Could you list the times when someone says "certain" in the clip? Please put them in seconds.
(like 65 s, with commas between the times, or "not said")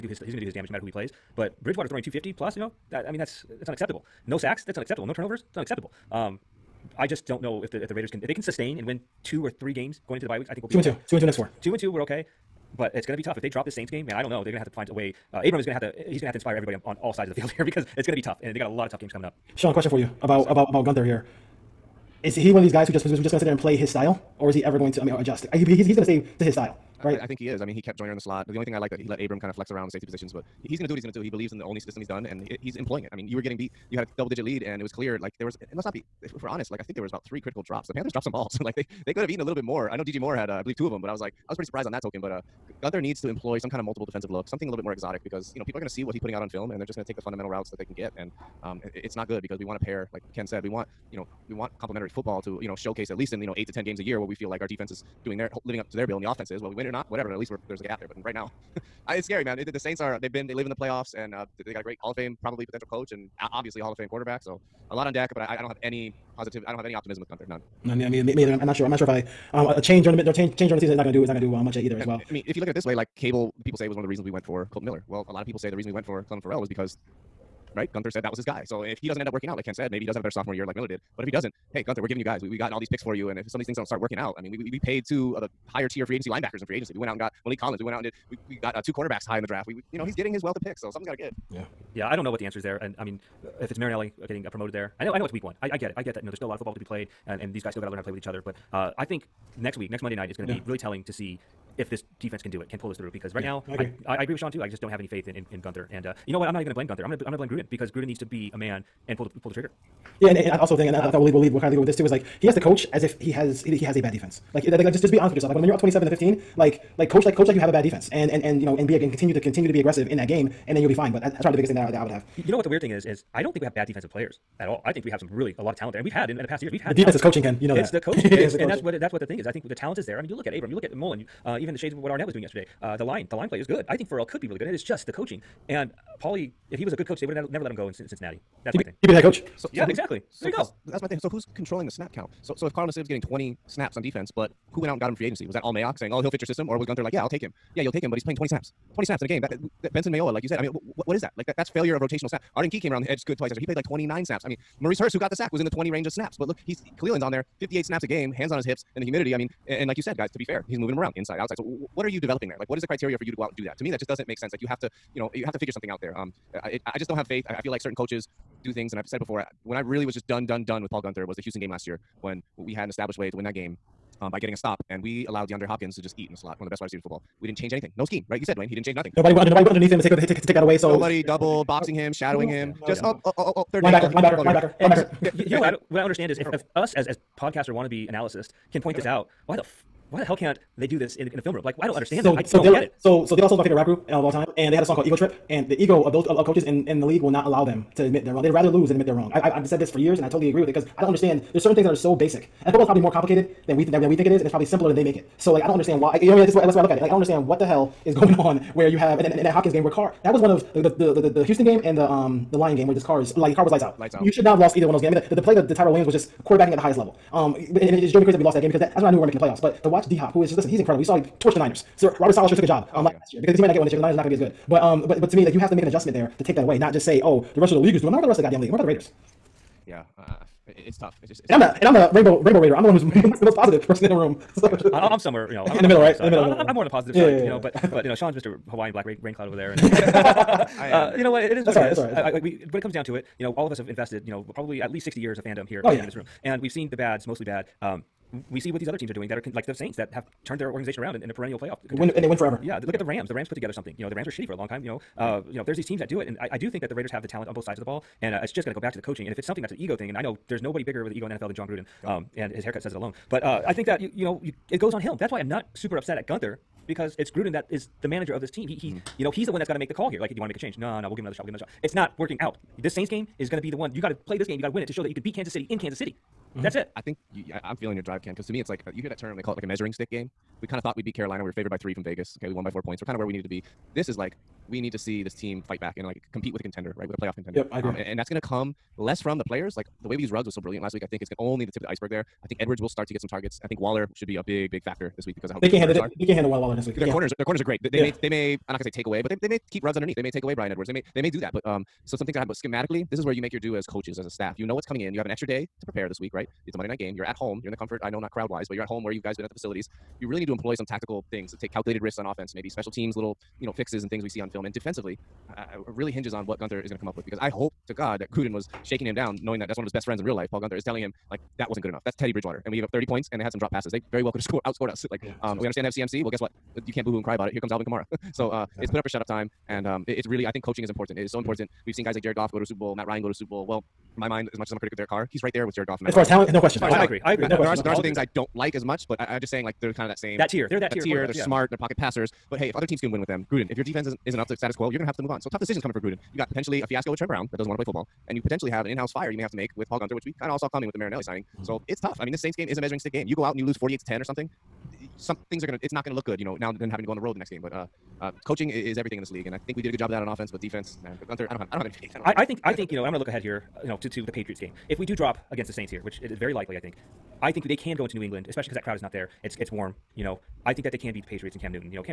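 167 s, 201 s.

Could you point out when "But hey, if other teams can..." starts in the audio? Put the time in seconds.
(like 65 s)
342 s.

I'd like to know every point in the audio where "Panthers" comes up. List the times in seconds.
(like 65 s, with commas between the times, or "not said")
37 s.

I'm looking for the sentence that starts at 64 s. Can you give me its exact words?
So a lot on deck, but I, I don't have any positive.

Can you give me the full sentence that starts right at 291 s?
I think it's gonna only the tip of the iceberg there.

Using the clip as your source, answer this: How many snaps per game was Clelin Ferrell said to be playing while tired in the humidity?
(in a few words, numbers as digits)
58.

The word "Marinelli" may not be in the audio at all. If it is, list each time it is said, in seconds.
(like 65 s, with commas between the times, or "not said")
93 s, 350 s.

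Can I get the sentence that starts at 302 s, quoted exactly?
But schematically, this is where you make your due as coaches, as a staff.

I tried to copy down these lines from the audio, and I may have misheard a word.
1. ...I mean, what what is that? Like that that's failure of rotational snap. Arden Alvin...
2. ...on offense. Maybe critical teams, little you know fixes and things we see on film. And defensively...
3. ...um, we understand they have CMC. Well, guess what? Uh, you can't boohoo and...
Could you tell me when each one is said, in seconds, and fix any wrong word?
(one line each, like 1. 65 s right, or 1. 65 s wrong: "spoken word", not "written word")
1. 150 s wrong: "Key", not "Alvin"
2. 312 s wrong: "special", not "critical"
3. 325 s right.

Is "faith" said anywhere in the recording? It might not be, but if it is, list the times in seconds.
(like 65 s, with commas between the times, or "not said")
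105 s, 167 s, 361 s.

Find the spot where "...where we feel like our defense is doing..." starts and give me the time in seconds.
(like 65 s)
54 s.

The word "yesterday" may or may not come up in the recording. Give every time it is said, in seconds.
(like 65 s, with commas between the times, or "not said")
132 s.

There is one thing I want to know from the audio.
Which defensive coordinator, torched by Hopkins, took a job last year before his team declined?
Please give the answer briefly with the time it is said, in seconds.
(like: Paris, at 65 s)
Robert Saleh, at 222 s.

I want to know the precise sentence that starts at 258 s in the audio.
And uh, it's just going to go back to the coaching.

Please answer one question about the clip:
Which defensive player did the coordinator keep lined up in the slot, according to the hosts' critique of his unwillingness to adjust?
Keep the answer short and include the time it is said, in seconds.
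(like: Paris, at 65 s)
Joyner, at 27 s.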